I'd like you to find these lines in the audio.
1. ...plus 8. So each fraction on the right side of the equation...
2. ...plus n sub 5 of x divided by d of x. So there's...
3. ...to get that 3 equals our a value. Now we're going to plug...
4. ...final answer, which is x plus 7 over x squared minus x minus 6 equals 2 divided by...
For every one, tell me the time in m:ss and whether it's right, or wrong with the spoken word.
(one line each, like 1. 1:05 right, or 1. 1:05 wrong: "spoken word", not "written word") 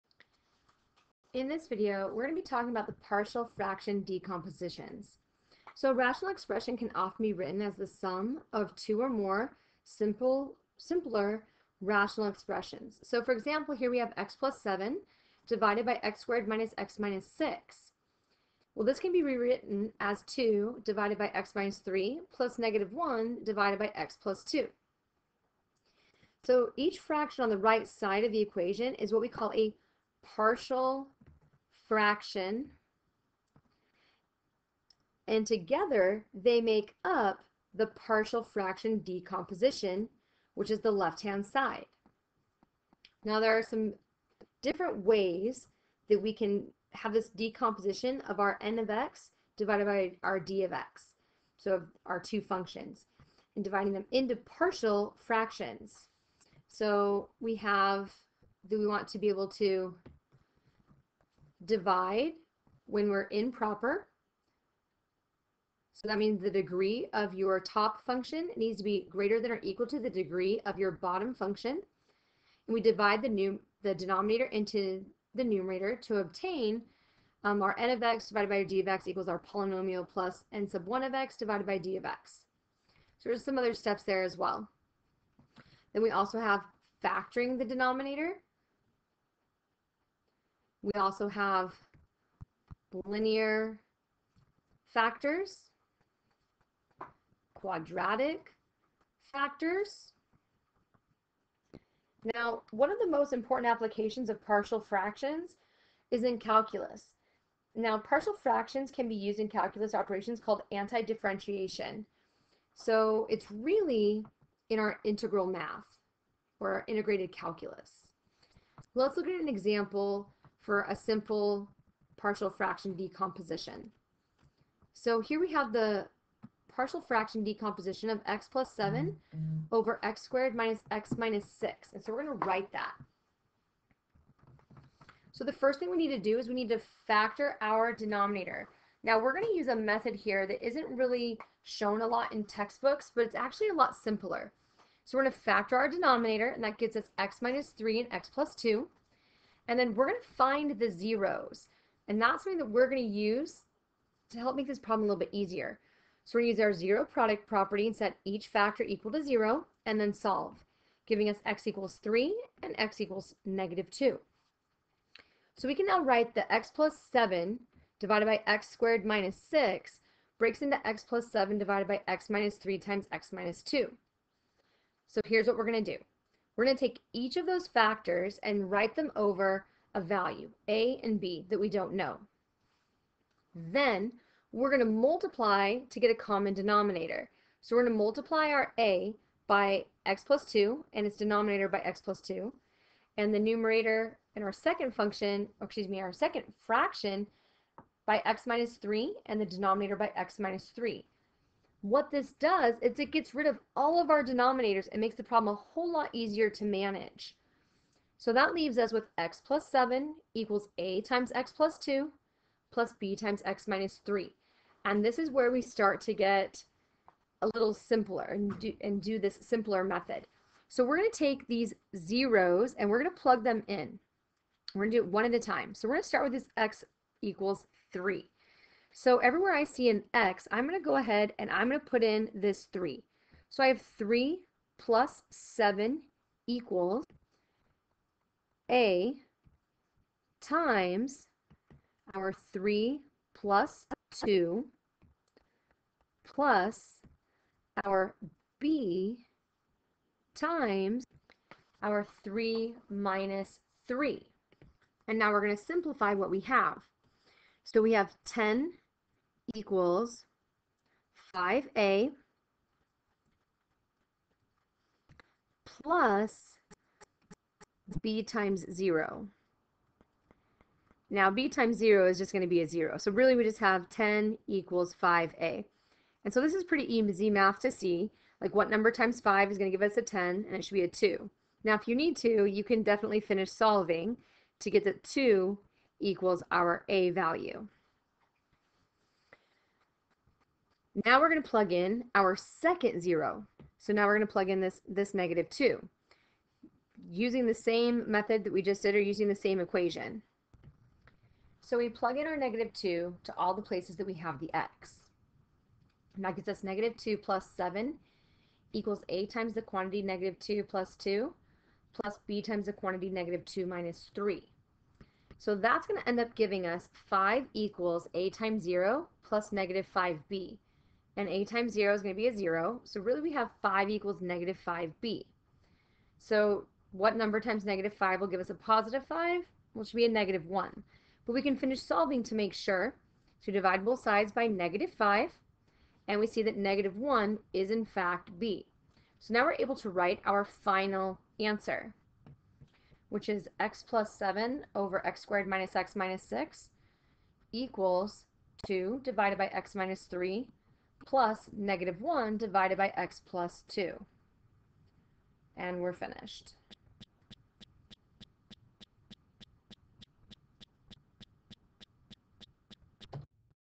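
1. 0:24 wrong: "2", not "8"
2. 1:20 wrong: "1", not "5"
3. 4:44 wrong: "2", not "3"
4. 5:40 right.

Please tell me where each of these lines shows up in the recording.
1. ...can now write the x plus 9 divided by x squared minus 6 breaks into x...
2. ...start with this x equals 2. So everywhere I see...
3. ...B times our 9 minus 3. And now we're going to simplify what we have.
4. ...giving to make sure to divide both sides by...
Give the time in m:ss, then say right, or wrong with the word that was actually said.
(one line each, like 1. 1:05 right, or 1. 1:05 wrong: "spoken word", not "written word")
1. 2:45 wrong: "7", not "9"
2. 3:46 wrong: "3", not "2"
3. 4:08 wrong: "3", not "9"
4. 5:31 wrong: "solving", not "giving".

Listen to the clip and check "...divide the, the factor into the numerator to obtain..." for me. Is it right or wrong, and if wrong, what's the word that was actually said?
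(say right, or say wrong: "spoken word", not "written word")
wrong: "denominator", not "factor".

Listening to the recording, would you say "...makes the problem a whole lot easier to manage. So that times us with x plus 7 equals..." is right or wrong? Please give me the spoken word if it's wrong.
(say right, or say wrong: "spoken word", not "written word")
wrong: "leaves", not "times".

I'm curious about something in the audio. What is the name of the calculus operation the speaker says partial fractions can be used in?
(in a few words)
anti-differentiation.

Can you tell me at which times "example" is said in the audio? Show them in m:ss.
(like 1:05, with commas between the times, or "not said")
0:13, 1:59.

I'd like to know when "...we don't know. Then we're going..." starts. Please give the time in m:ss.
3:01.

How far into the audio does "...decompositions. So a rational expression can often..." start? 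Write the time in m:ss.
0:04.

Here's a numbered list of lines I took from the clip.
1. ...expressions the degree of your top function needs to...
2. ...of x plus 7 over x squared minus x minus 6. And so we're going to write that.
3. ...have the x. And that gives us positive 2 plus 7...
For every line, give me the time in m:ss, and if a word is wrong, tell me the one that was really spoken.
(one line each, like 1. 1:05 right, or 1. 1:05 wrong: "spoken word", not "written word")
1. 1:06 wrong: "means", not "expressions"
2. 2:08 right
3. 5:04 wrong: "negative", not "positive".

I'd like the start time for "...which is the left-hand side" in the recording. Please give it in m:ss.
0:40.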